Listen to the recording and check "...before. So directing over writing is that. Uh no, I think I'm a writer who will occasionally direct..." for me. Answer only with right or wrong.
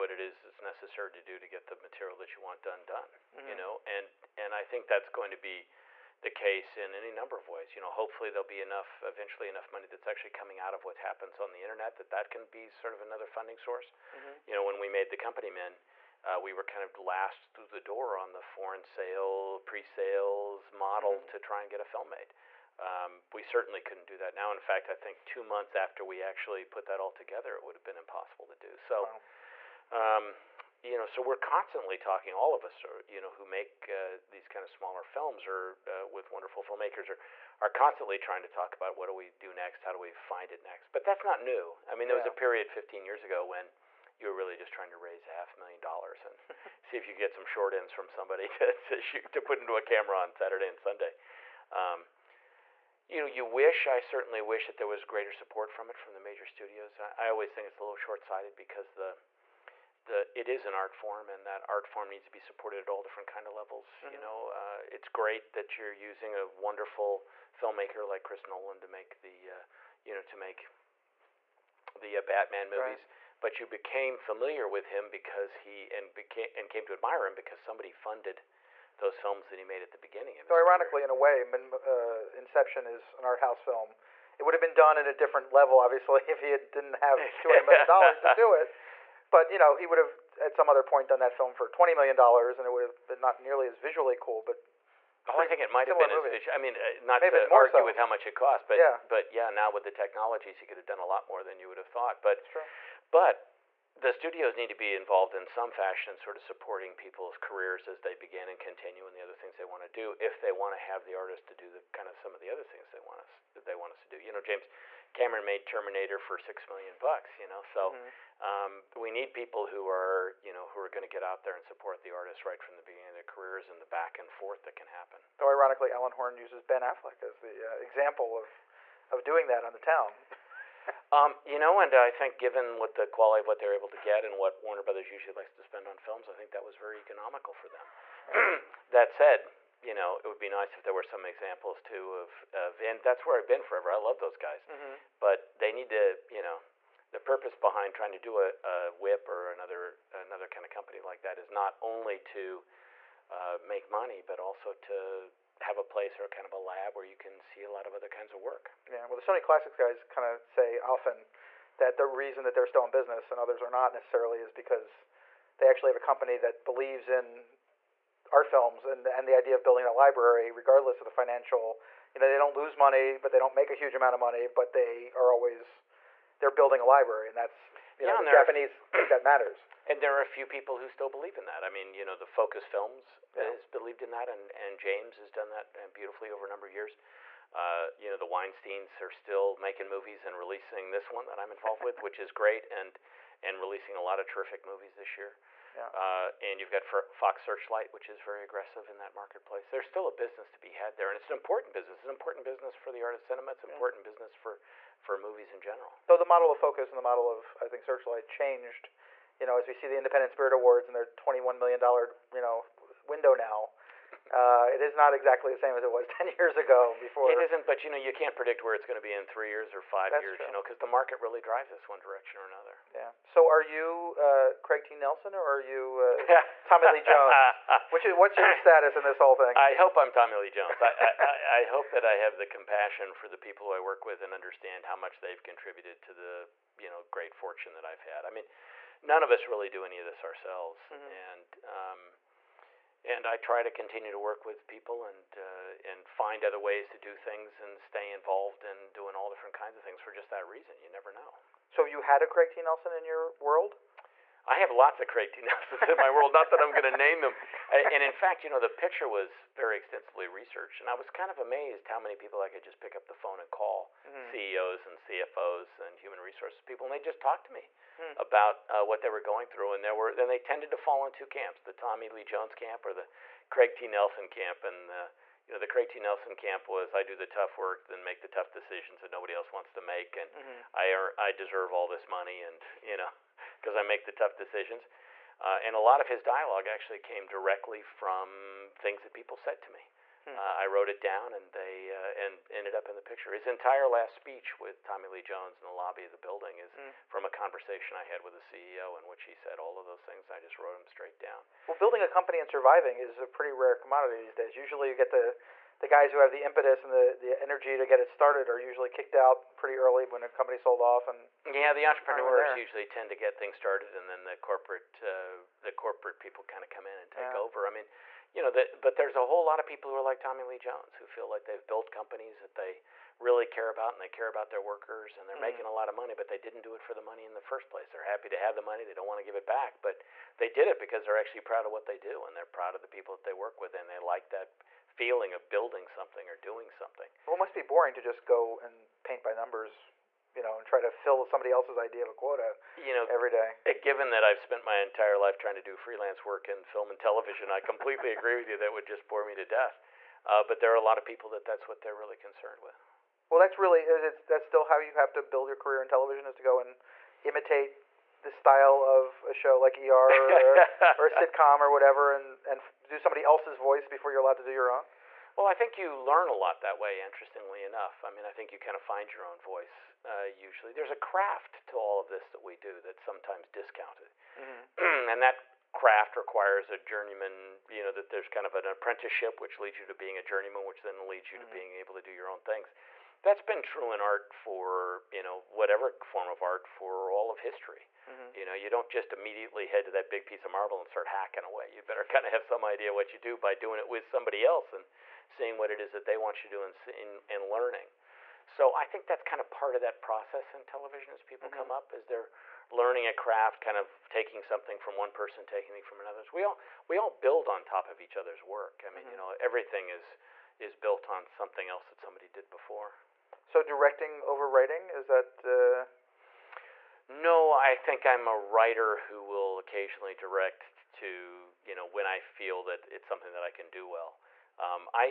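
right.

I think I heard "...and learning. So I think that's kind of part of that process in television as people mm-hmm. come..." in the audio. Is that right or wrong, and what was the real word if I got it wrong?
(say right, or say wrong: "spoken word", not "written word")
right.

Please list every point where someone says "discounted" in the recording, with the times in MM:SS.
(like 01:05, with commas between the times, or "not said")
06:13.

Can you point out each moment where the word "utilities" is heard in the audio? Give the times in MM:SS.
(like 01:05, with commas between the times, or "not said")
not said.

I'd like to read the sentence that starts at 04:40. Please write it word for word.
I, I deserve all this money, and you know, because I make the tough decisions.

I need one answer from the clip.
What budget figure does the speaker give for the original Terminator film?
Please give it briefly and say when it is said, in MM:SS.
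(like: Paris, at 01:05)
6 million, at 01:56.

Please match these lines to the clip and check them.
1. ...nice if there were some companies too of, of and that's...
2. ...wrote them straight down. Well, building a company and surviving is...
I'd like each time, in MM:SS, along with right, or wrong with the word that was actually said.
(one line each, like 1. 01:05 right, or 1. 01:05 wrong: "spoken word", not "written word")
1. 02:20 wrong: "examples", not "companies"
2. 05:00 right.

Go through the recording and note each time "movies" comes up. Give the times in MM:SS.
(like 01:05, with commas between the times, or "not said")
01:12, 01:36, 03:09, 03:14, 03:25.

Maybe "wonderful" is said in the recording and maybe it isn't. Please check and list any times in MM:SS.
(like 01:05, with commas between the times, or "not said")
00:36, 01:06.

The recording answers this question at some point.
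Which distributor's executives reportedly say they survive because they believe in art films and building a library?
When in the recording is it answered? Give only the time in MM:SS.
02:39.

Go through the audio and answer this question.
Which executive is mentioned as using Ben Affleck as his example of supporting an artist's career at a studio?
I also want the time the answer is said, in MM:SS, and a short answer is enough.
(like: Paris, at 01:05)
Alan Horn, at 02:05.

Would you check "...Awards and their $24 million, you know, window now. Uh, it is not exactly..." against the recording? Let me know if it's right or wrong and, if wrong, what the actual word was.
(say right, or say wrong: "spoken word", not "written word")
wrong: "21", not "24".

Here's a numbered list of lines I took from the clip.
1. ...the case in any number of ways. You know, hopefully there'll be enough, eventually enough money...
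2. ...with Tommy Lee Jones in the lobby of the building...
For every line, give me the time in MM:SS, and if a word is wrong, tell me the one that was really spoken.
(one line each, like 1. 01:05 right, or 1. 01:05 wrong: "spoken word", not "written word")
1. 00:06 right
2. 04:54 right.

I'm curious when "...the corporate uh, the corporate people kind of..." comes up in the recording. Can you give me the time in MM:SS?
05:14.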